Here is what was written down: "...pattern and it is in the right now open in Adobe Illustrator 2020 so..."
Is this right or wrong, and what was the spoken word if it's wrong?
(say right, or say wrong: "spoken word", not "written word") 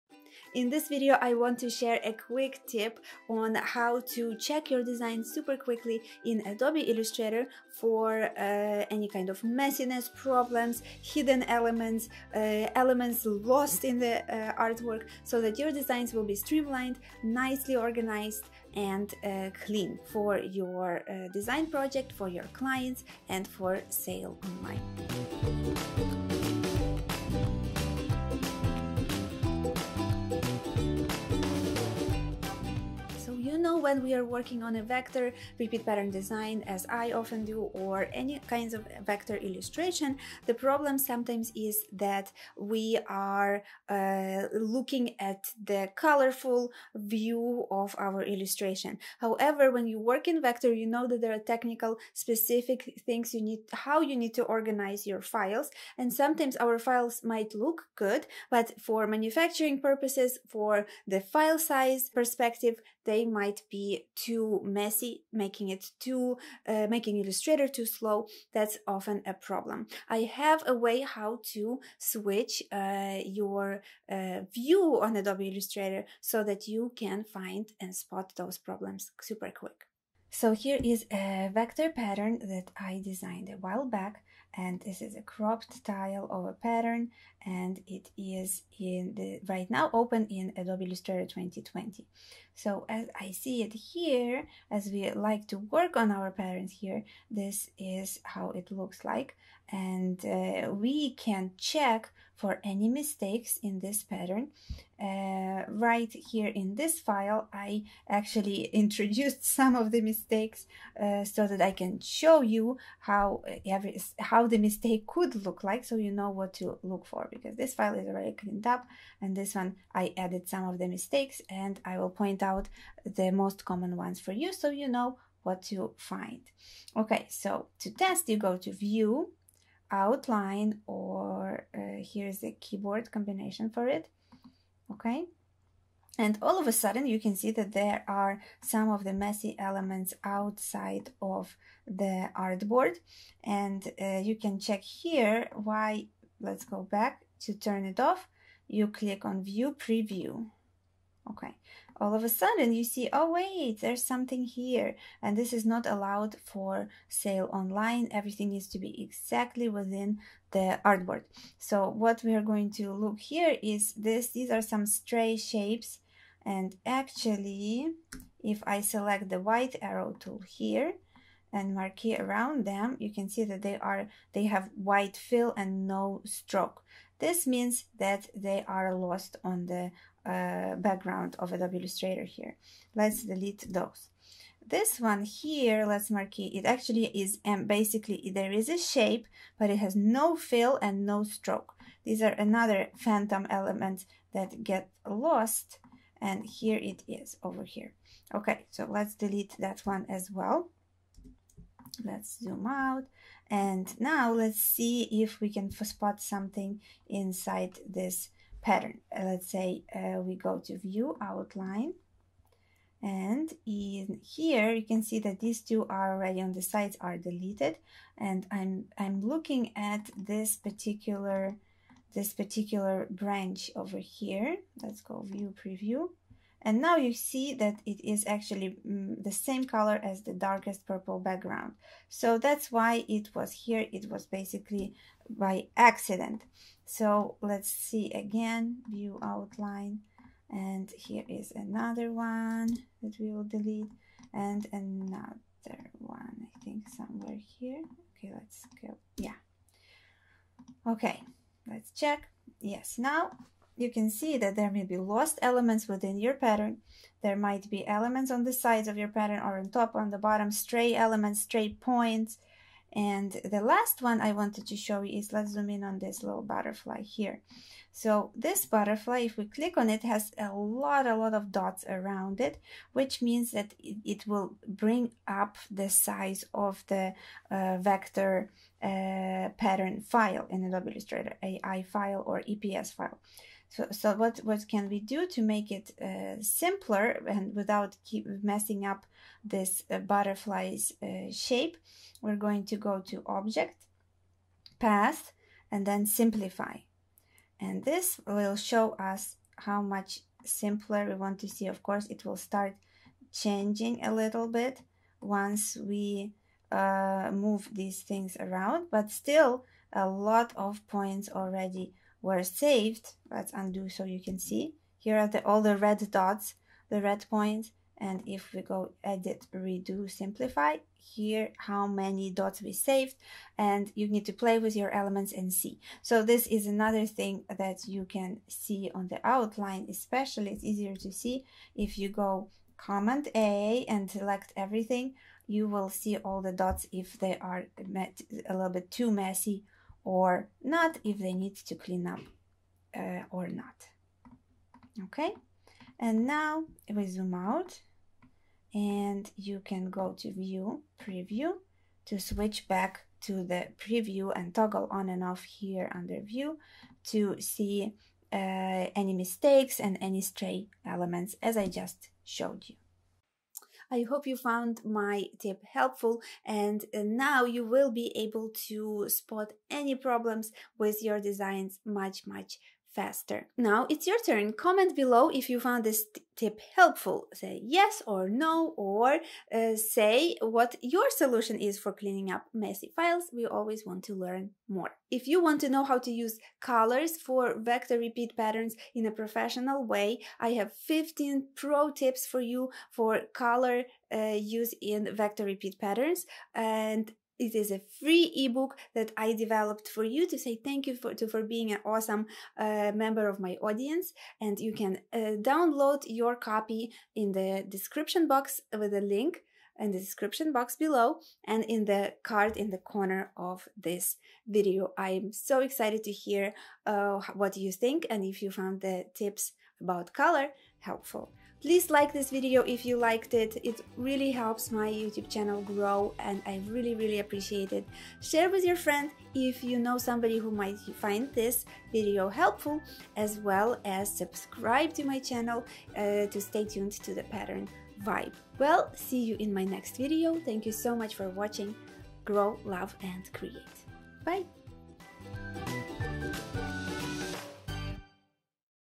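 right.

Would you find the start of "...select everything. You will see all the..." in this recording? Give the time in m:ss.
5:34.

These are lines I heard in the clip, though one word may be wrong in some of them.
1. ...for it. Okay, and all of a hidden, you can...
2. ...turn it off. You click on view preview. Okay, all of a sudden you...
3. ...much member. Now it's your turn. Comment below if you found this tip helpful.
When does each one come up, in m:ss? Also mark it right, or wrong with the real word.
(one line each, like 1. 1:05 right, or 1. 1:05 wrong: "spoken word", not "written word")
1. 2:13 wrong: "sudden", not "hidden"
2. 2:27 right
3. 6:12 wrong: "faster", not "member".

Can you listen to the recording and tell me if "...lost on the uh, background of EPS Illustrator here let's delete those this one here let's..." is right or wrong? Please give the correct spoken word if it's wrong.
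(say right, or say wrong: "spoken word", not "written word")
wrong: "Adobe", not "EPS".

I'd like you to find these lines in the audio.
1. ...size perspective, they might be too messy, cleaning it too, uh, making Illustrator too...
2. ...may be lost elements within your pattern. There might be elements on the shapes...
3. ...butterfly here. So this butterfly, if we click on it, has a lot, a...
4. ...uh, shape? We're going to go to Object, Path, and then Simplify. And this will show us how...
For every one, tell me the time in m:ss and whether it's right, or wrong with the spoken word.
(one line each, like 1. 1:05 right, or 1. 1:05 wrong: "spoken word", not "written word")
1. 1:01 wrong: "making", not "cleaning"
2. 4:14 wrong: "sides", not "shapes"
3. 4:26 right
4. 4:51 right.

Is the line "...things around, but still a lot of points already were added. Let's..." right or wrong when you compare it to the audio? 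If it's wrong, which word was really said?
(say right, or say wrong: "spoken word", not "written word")
wrong: "saved", not "added".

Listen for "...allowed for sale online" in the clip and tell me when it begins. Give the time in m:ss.
2:35.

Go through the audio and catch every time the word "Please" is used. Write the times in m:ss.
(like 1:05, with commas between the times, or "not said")
7:01.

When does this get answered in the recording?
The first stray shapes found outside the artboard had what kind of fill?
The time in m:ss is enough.
2:54.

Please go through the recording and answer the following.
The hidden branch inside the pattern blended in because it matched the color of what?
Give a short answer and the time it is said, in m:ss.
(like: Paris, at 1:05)
Darkest purple background, at 3:50.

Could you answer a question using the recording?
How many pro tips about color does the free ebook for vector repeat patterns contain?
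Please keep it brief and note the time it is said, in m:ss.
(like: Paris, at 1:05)
15, at 6:30.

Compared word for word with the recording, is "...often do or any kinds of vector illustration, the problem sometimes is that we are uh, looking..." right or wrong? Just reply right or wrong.
right.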